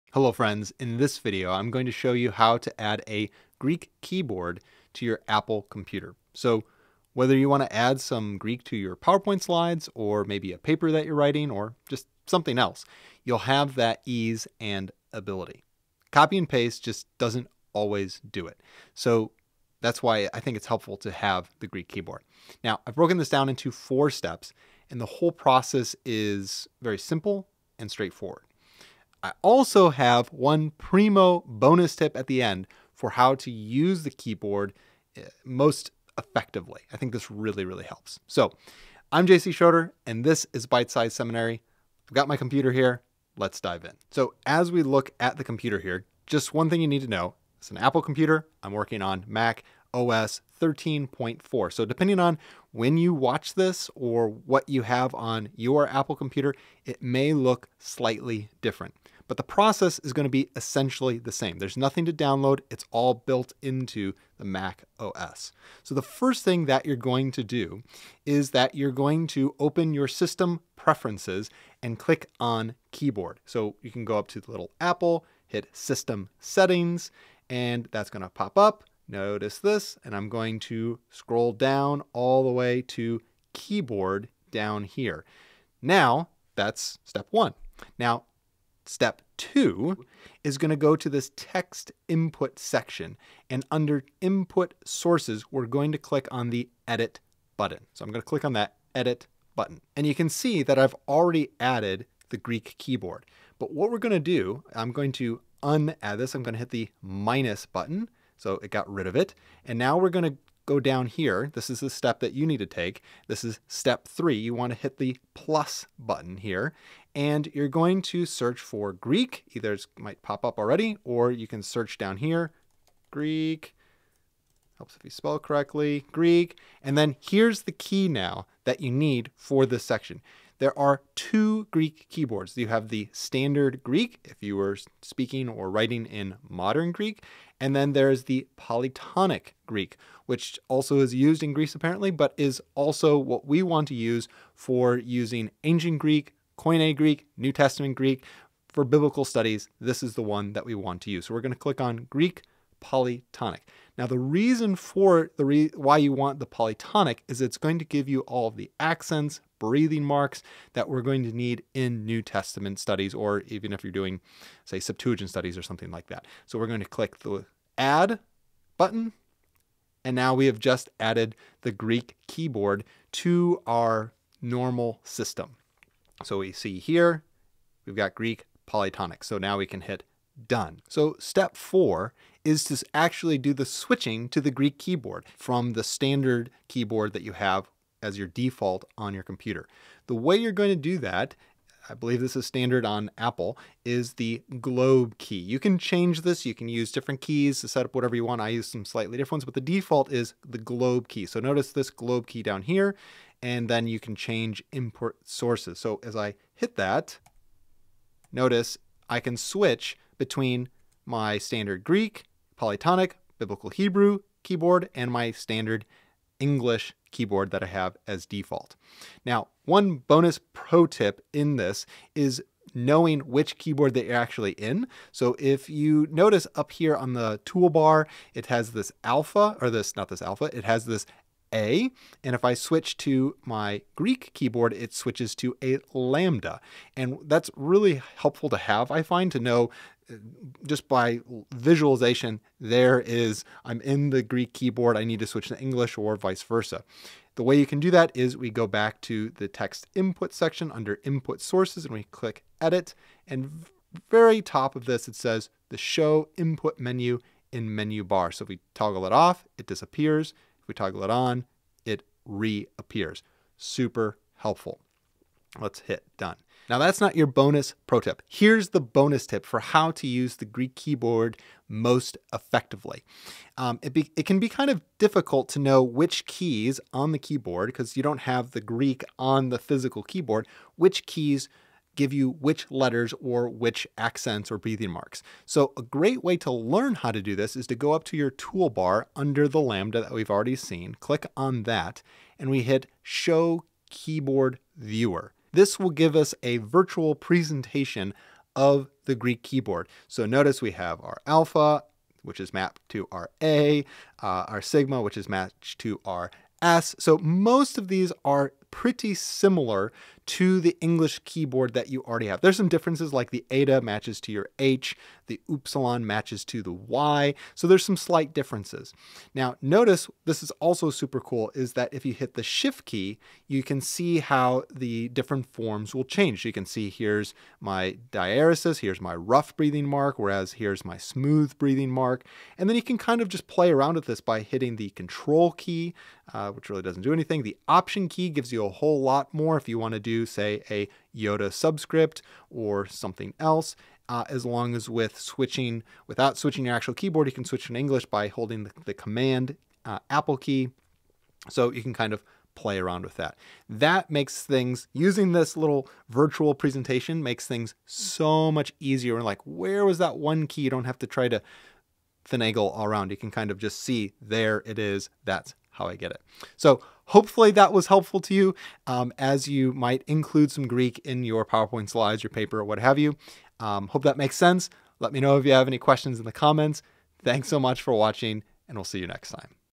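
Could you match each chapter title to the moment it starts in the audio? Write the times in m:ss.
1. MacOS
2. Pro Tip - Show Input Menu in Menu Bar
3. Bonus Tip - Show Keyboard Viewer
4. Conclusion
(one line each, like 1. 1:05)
1. 0:44
2. 3:41
3. 4:26
4. 6:06.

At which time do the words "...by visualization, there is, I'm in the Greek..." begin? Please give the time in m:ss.
4:00.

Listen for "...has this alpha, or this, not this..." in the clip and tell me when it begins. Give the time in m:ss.
3:48.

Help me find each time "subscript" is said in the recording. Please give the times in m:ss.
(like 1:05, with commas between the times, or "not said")
5:41.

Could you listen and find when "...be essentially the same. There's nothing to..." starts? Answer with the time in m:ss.
1:00.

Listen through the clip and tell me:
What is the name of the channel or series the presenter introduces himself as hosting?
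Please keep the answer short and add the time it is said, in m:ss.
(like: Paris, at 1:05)
Bite Size Seminary, at 0:40.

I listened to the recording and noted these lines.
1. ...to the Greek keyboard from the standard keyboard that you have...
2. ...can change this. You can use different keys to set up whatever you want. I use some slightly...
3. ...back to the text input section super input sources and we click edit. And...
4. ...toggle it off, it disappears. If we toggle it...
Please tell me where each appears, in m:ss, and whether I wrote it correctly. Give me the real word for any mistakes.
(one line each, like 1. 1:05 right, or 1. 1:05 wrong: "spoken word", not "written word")
1. 3:04 right
2. 3:15 right
3. 4:08 wrong: "under", not "super"
4. 4:18 right.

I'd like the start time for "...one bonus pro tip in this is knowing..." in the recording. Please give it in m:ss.
3:39.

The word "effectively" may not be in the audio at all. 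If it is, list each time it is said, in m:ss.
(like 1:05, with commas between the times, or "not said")
0:36, 4:32.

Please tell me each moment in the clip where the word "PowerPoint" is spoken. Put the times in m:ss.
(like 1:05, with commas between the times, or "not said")
0:08, 6:11.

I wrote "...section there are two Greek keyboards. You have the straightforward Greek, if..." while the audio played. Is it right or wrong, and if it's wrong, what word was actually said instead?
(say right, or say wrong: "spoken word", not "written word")
wrong: "standard", not "straightforward".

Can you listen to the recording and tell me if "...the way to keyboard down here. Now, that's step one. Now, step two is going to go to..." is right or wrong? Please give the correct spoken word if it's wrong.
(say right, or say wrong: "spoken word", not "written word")
right.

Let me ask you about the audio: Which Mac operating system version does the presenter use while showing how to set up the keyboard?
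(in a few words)
macOS 13.4.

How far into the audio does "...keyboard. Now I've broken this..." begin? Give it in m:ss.
0:21.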